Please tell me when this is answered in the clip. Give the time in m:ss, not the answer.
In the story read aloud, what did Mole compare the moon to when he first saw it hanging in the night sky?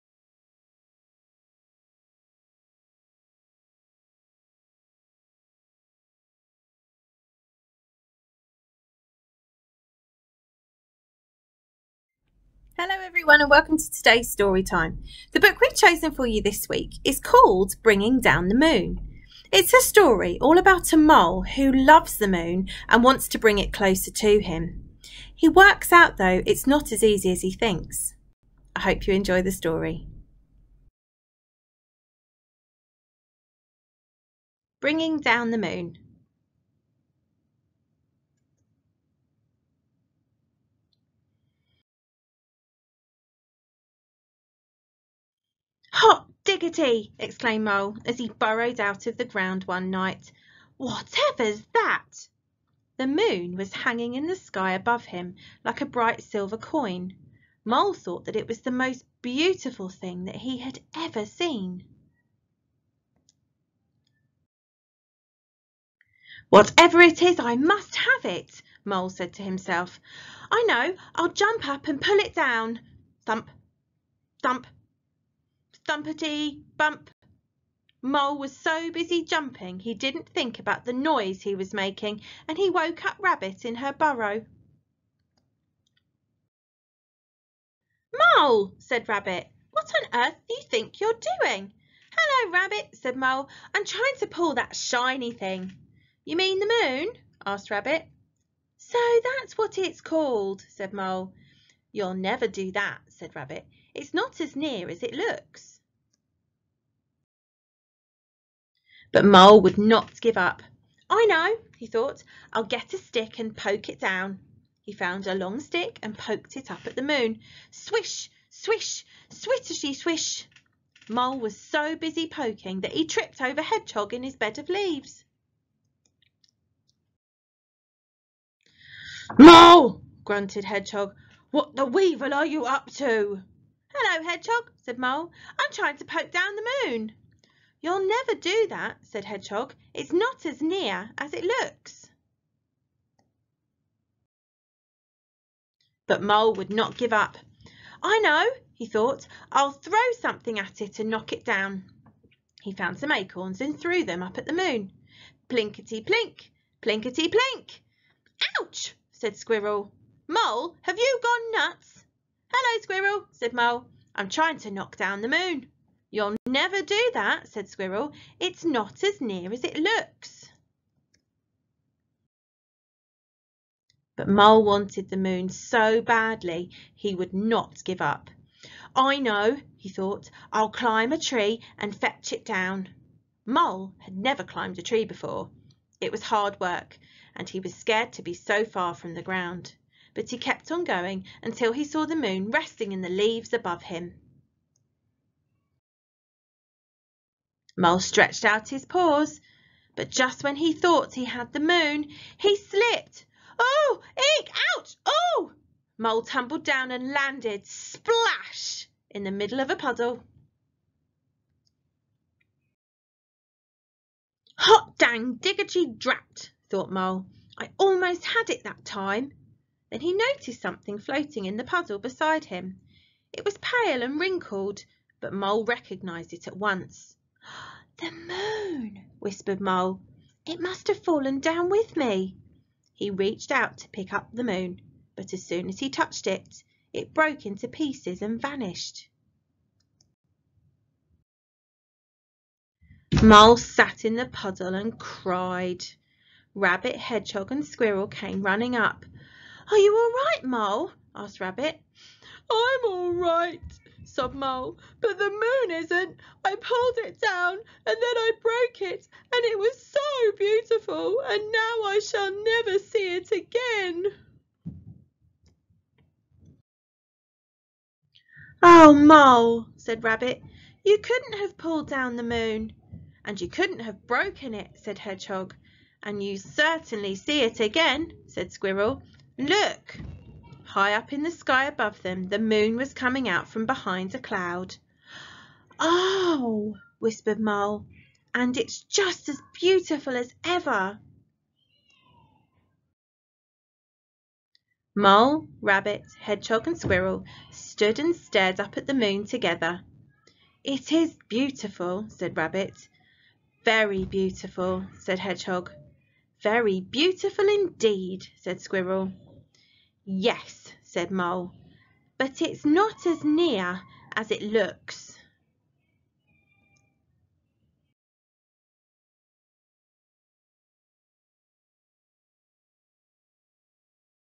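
0:55.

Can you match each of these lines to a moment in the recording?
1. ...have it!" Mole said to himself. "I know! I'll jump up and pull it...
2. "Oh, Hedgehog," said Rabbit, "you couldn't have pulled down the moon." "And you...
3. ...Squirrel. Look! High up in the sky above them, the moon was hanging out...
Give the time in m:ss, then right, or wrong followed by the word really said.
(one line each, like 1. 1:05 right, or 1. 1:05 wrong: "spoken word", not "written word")
1. 1:07 right
2. 4:28 wrong: "Mole", not "Hedgehog"
3. 4:38 wrong: "coming", not "hanging".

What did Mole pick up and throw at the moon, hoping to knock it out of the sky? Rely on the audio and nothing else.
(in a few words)
acorns.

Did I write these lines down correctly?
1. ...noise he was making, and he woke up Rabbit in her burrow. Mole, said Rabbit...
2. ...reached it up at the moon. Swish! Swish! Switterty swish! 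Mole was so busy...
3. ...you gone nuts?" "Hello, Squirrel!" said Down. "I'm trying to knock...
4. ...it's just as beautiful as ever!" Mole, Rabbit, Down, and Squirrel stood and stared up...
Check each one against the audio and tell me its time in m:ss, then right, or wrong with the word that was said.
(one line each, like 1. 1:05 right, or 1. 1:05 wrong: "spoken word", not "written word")
1. 1:20 right
2. 1:56 wrong: "poked", not "reached"
3. 2:40 wrong: "Mole", not "Down"
4. 4:48 wrong: "Hedgehog", not "Down".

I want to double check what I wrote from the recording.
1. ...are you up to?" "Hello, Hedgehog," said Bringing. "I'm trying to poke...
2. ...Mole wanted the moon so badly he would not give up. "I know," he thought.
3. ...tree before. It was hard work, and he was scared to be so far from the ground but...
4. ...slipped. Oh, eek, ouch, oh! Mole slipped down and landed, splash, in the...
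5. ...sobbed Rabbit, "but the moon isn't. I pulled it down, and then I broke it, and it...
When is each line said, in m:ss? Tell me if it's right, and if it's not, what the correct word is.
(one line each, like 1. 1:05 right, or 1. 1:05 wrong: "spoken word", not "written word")
1. 2:12 wrong: "Mole", not "Bringing"
2. 2:54 right
3. 3:04 right
4. 3:22 wrong: "tumbled", not "slipped"
5. 4:14 wrong: "Mole", not "Rabbit".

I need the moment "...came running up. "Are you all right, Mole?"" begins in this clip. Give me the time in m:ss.
4:08.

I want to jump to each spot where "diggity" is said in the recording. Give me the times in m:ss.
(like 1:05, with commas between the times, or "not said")
0:46, 3:35.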